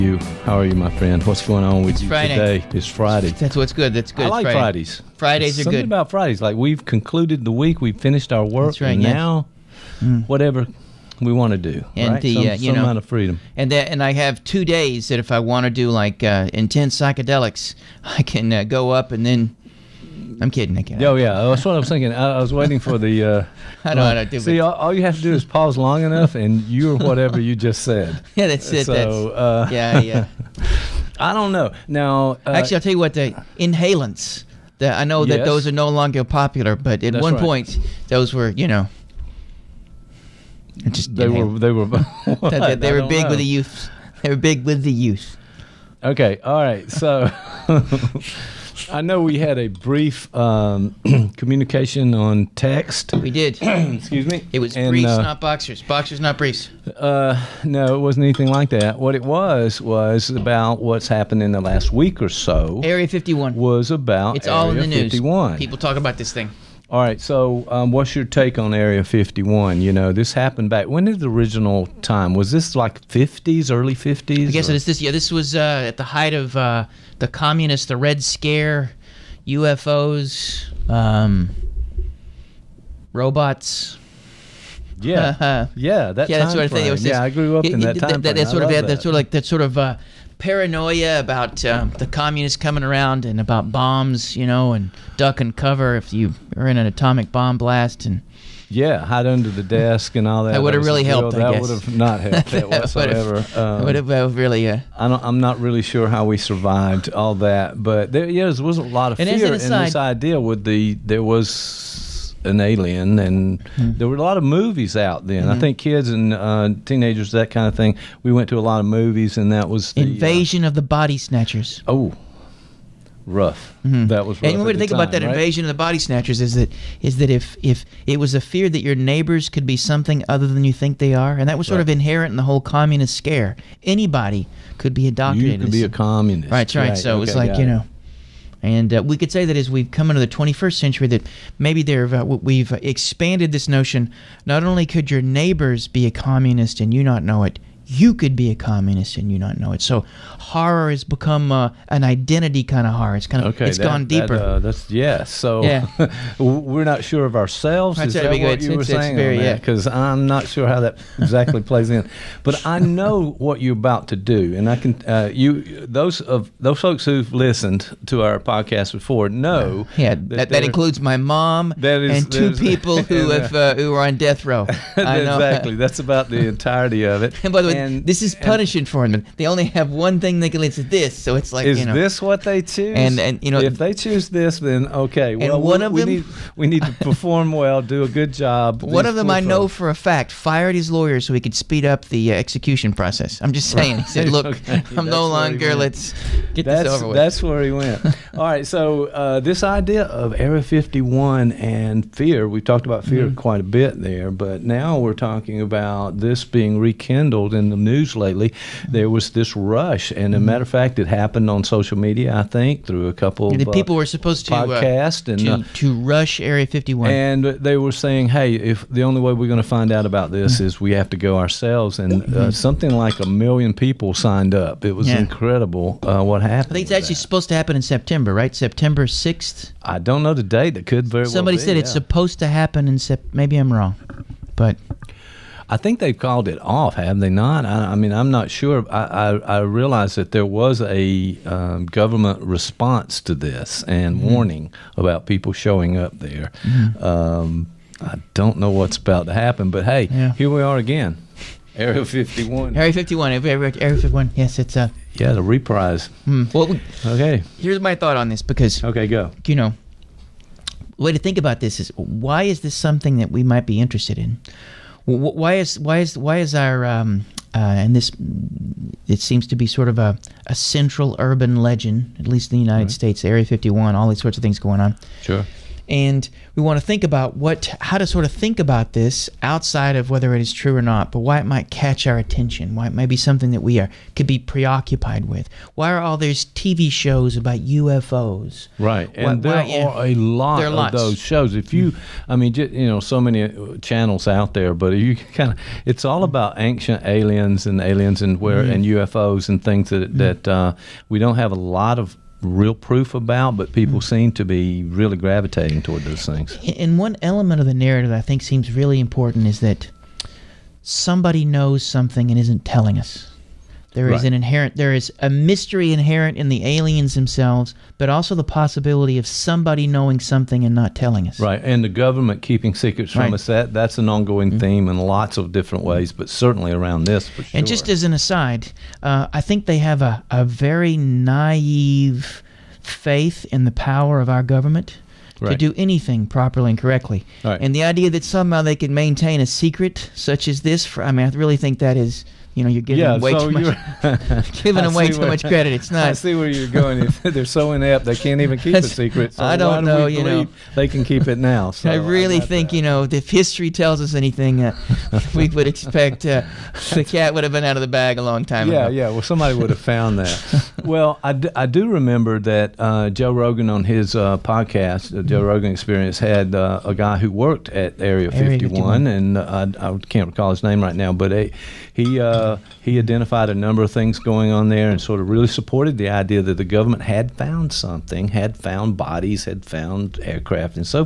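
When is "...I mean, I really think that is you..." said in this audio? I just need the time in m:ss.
5:41.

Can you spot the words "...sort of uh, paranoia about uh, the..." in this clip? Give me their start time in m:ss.
1:29.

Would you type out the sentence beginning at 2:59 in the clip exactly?
They only have one thing then they can listen to this.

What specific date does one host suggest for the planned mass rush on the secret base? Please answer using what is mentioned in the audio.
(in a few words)
September 6th.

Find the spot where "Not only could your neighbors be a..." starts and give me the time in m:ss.
2:24.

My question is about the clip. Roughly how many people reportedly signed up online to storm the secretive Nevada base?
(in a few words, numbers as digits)
a million.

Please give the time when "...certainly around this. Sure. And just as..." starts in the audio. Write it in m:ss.
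5:26.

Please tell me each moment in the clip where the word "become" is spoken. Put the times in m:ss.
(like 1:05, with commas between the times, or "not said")
2:31.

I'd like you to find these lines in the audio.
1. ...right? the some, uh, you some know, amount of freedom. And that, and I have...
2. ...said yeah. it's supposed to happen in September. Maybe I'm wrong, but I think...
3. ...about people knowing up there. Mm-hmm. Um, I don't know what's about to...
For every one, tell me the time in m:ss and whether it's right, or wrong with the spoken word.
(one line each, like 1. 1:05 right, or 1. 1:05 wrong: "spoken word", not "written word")
1. 0:12 right
2. 3:51 right
3. 4:04 wrong: "showing", not "knowing".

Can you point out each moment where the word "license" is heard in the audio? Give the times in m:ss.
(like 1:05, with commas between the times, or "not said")
not said.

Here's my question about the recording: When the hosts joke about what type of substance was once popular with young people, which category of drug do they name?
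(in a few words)
Inhalants.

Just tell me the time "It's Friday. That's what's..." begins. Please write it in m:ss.
0:02.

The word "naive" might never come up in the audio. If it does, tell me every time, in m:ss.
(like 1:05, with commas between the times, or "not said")
5:30.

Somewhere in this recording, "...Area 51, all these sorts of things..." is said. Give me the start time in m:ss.
4:33.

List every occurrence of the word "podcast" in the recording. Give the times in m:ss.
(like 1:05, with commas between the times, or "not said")
2:48, 3:34, 6:04.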